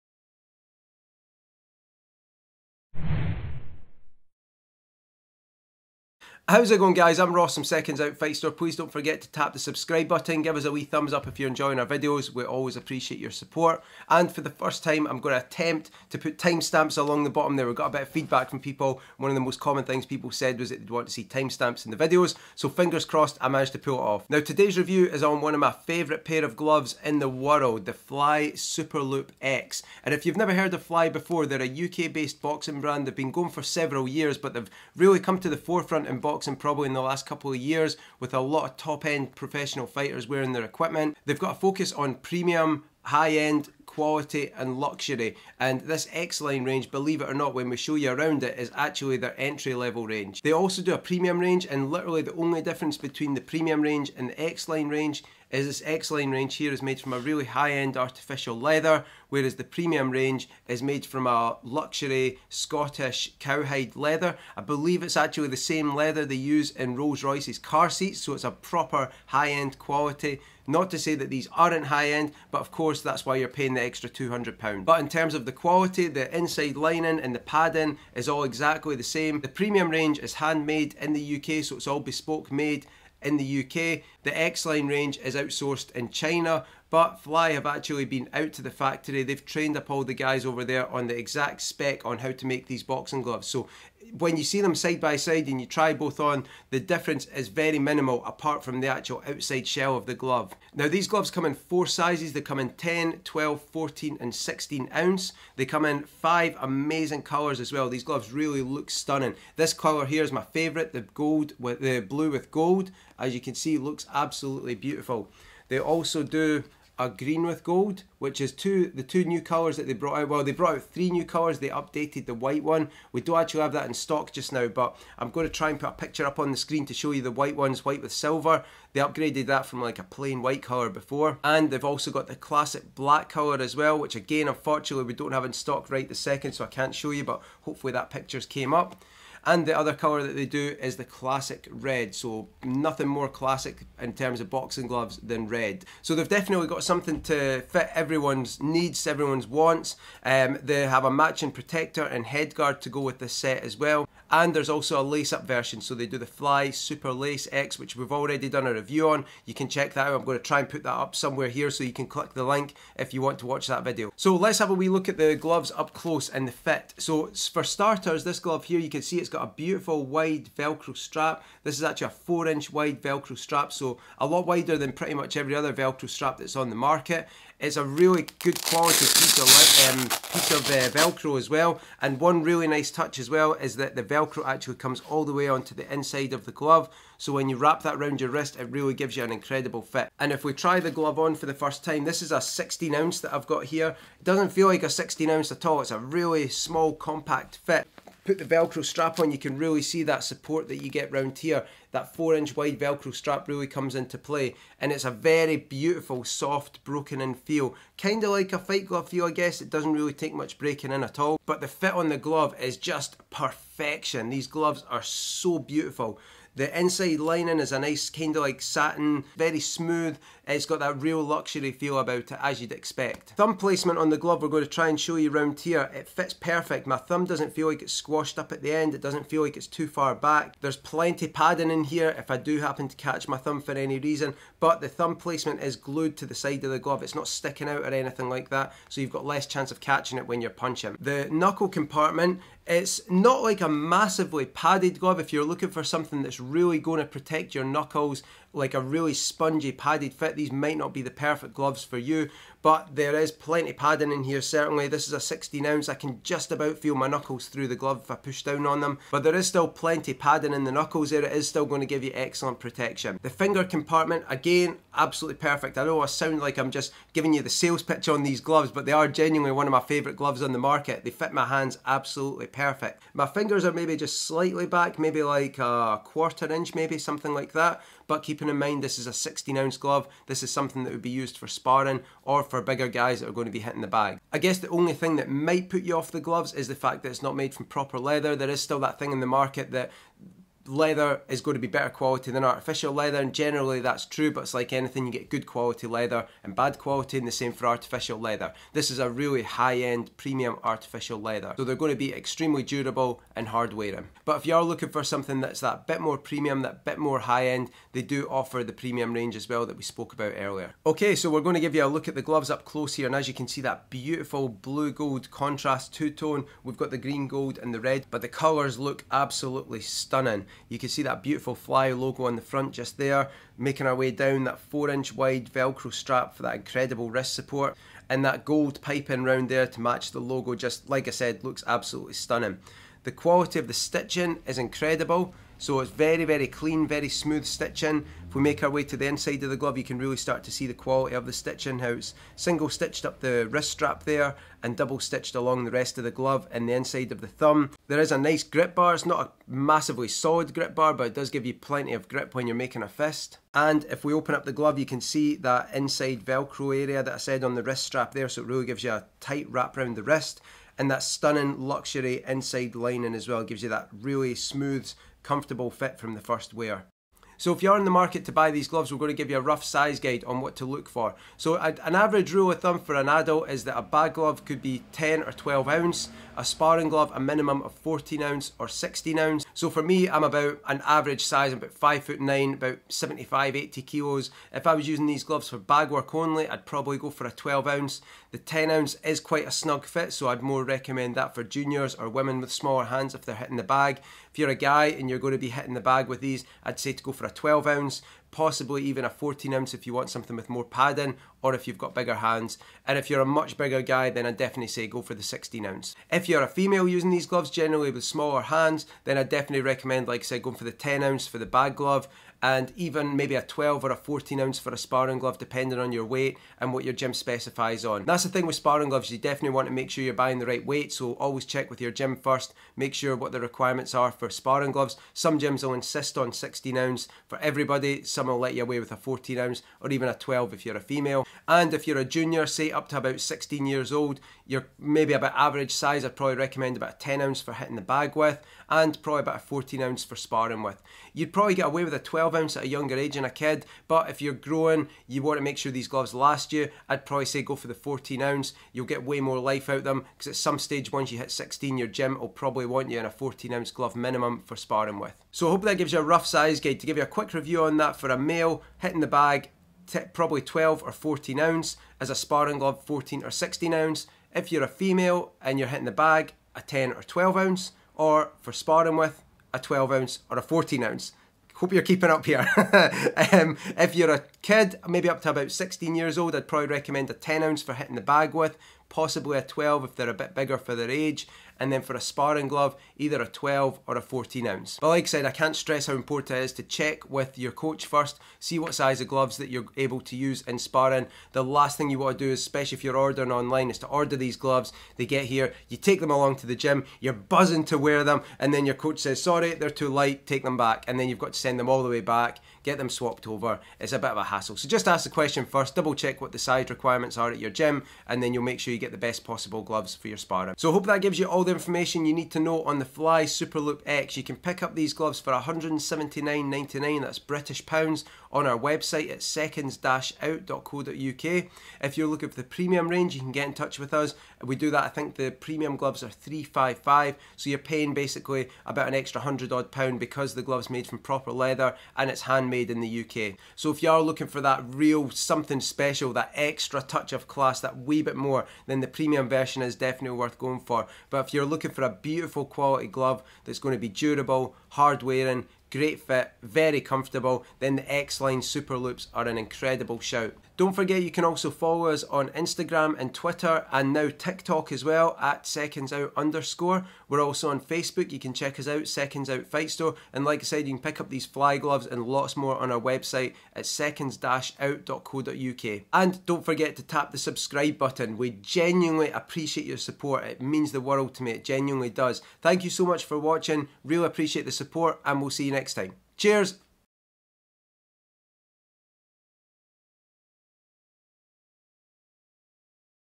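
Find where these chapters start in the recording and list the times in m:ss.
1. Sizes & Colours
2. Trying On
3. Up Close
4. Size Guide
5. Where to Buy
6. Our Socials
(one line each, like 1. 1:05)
1. 1:41
2. 2:44
3. 5:10
4. 6:07
5. 8:30
6. 9:10.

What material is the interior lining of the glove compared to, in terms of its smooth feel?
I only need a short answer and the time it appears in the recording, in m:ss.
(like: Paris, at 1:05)
Satin, at 3:38.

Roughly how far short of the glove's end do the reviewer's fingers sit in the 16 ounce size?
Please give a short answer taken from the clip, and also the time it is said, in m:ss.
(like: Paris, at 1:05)
A quarter inch, at 4:35.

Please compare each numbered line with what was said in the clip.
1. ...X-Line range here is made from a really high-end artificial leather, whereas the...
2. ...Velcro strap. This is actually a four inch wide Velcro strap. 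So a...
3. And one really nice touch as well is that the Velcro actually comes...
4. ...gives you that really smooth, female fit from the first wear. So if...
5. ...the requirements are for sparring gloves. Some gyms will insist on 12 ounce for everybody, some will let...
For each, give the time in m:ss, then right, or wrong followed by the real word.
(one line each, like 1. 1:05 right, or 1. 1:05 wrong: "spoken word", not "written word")
1. 0:55 right
2. 2:50 right
3. 3:02 right
4. 6:03 wrong: "comfortable", not "female"
5. 7:03 wrong: "16", not "12".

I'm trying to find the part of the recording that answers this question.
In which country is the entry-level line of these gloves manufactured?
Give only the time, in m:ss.
1:26.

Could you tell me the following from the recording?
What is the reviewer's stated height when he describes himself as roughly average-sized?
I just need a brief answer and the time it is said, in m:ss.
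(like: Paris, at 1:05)
5 foot 9, at 6:21.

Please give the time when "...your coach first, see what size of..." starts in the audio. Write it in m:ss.
8:07.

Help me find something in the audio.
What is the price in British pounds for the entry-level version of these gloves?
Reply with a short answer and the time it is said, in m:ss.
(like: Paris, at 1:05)
179.99, at 8:35.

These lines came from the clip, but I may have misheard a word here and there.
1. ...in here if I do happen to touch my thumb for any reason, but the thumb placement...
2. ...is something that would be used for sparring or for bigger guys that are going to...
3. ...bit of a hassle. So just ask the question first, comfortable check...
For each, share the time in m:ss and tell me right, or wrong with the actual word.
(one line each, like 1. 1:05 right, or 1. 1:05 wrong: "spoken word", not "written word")
1. 3:51 wrong: "catch", not "touch"
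2. 4:40 right
3. 8:23 wrong: "double", not "comfortable".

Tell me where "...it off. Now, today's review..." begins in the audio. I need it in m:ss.
0:23.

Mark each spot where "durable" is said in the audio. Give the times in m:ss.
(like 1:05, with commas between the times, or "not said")
5:02, 9:03.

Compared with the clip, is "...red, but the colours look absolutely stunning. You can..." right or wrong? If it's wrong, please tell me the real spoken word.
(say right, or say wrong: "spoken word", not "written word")
right.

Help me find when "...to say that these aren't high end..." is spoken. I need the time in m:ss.
1:10.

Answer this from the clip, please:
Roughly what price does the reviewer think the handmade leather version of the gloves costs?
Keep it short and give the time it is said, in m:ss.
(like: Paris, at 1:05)
355, at 8:46.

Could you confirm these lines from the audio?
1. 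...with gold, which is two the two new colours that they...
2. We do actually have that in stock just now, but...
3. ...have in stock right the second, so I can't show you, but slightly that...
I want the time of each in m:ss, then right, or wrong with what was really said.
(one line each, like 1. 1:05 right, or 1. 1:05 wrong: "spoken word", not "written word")
1. 1:57 right
2. 2:03 right
3. 2:15 wrong: "hopefully", not "slightly".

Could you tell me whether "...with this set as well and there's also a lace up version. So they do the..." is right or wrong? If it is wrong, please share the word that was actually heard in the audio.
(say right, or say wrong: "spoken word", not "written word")
right.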